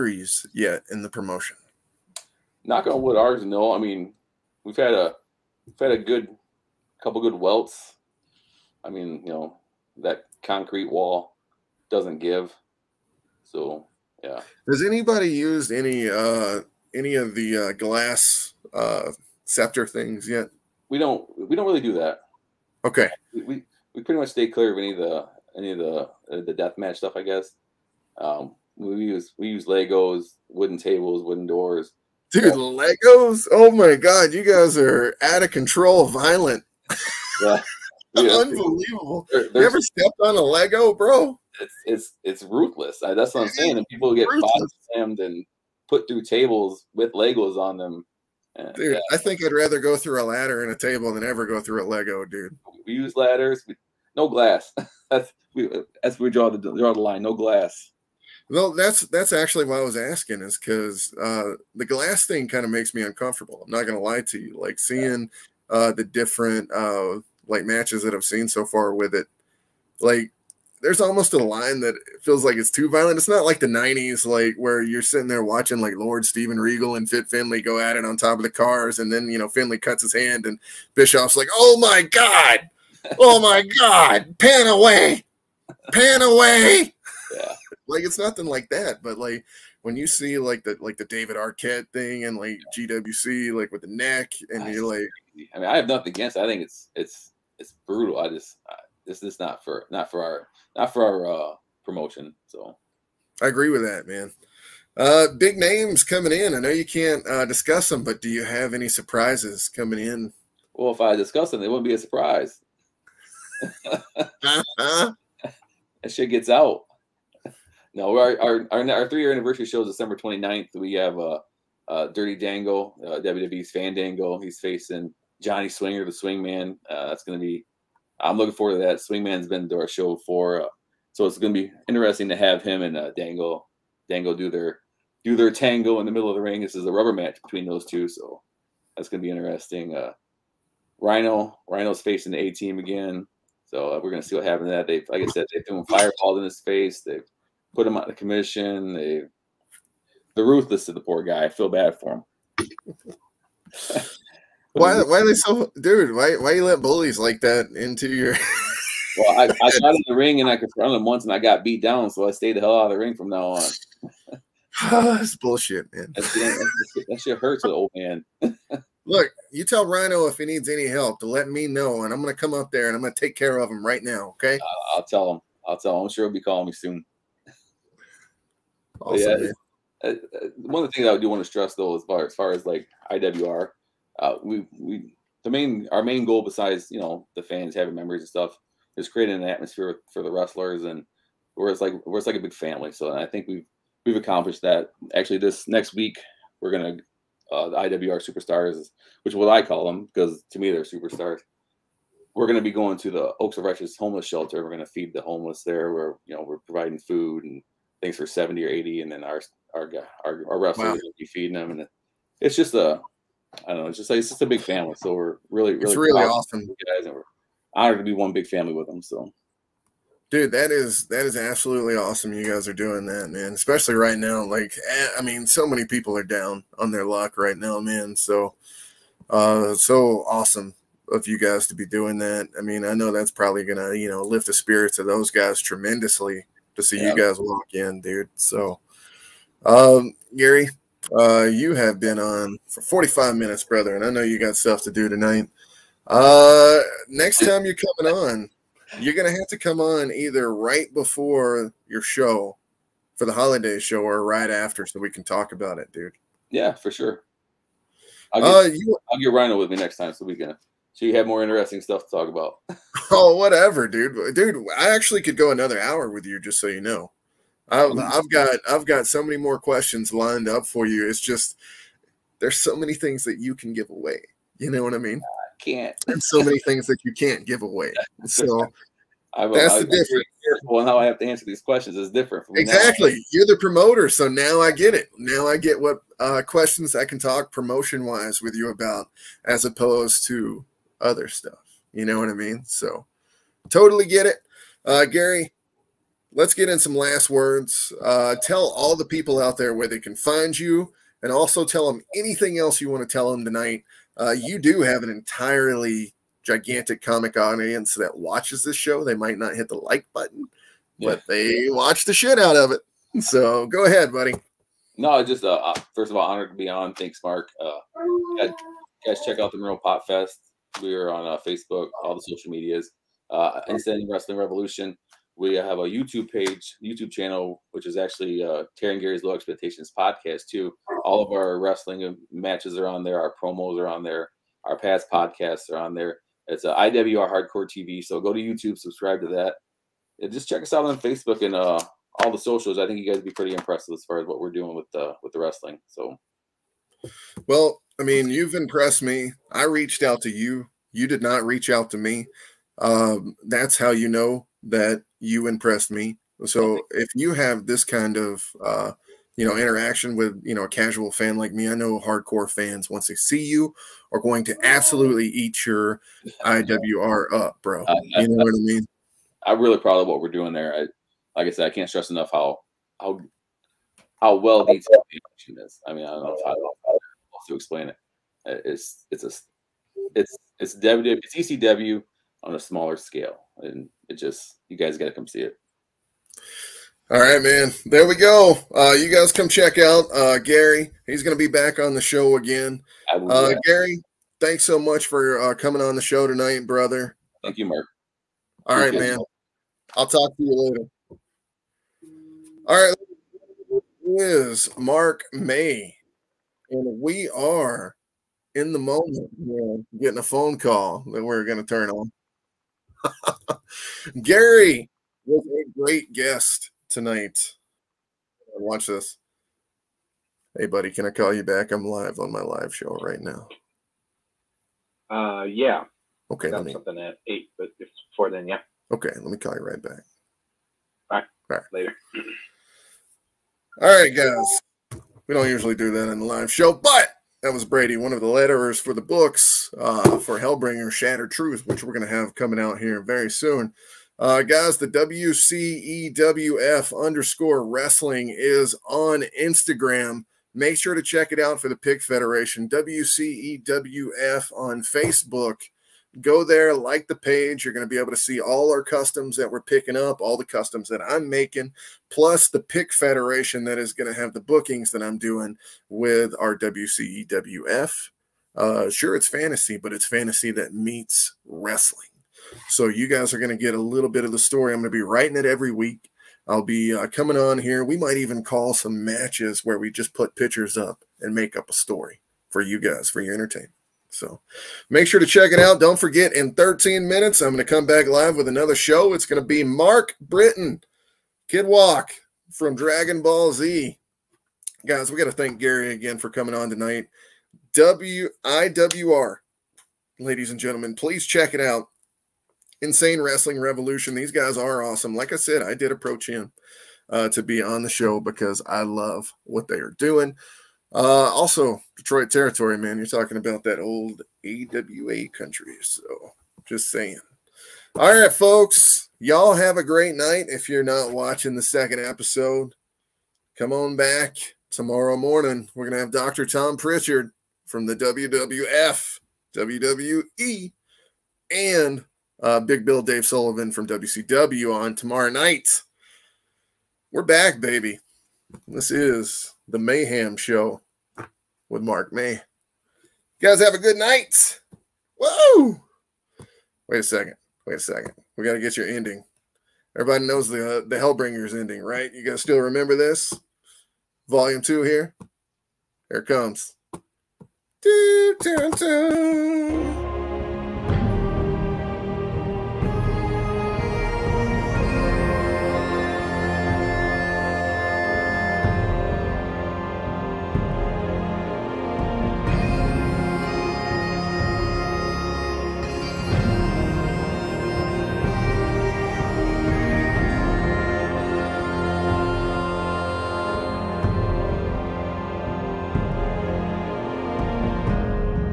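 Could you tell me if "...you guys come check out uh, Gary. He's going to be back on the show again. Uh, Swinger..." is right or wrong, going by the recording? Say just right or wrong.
wrong.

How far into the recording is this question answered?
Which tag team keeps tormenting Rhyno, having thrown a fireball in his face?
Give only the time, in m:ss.
2:22.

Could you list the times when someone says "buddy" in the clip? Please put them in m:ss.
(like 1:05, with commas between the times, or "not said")
5:14, 7:00.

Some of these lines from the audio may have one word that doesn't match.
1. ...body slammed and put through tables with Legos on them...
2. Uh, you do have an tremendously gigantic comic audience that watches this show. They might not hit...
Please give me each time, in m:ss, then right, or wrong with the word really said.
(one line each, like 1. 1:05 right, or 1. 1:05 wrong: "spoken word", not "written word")
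1. 0:44 right
2. 5:04 wrong: "entirely", not "tremendously".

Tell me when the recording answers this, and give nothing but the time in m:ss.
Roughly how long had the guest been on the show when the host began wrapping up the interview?
4:02.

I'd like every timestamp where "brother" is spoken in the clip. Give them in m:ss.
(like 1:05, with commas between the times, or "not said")
4:03, 6:36.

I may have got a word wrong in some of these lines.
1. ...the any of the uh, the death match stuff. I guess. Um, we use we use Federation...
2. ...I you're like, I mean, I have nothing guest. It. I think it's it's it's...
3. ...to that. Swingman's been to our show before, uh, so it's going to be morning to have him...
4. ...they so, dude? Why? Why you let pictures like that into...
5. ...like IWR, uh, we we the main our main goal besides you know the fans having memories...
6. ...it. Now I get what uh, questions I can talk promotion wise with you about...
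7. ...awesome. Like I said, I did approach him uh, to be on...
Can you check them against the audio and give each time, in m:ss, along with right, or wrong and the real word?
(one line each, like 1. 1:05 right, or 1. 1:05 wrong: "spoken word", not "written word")
1. 0:24 wrong: "Legos", not "Federation"
2. 1:34 wrong: "against", not "guest"
3. 2:08 wrong: "interesting", not "morning"
4. 2:35 wrong: "bullies", not "pictures"
5. 3:02 right
6. 4:44 right
7. 8:24 right.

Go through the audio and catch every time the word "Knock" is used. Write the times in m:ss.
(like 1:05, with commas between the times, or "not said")
0:02.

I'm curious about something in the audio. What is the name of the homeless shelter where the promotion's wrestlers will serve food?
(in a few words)
Oaks of Righteous.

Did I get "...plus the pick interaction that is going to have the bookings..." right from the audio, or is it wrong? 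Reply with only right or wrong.
wrong.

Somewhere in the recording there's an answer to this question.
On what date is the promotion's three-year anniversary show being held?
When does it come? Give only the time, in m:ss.
1:59.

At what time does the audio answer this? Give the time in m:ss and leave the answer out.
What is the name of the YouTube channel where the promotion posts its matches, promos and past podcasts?
5:36.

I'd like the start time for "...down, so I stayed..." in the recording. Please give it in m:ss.
2:41.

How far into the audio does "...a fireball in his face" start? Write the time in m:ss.
2:25.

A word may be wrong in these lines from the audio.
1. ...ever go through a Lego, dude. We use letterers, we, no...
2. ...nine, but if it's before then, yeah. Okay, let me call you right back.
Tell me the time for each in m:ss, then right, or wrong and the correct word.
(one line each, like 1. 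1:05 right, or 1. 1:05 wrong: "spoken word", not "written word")
1. 0:51 wrong: "ladders", not "letterers"
2. 7:07 wrong: "eight", not "nine".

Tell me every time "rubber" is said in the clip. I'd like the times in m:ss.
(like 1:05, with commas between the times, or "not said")
2:16.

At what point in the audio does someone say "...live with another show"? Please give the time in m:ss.
8:08.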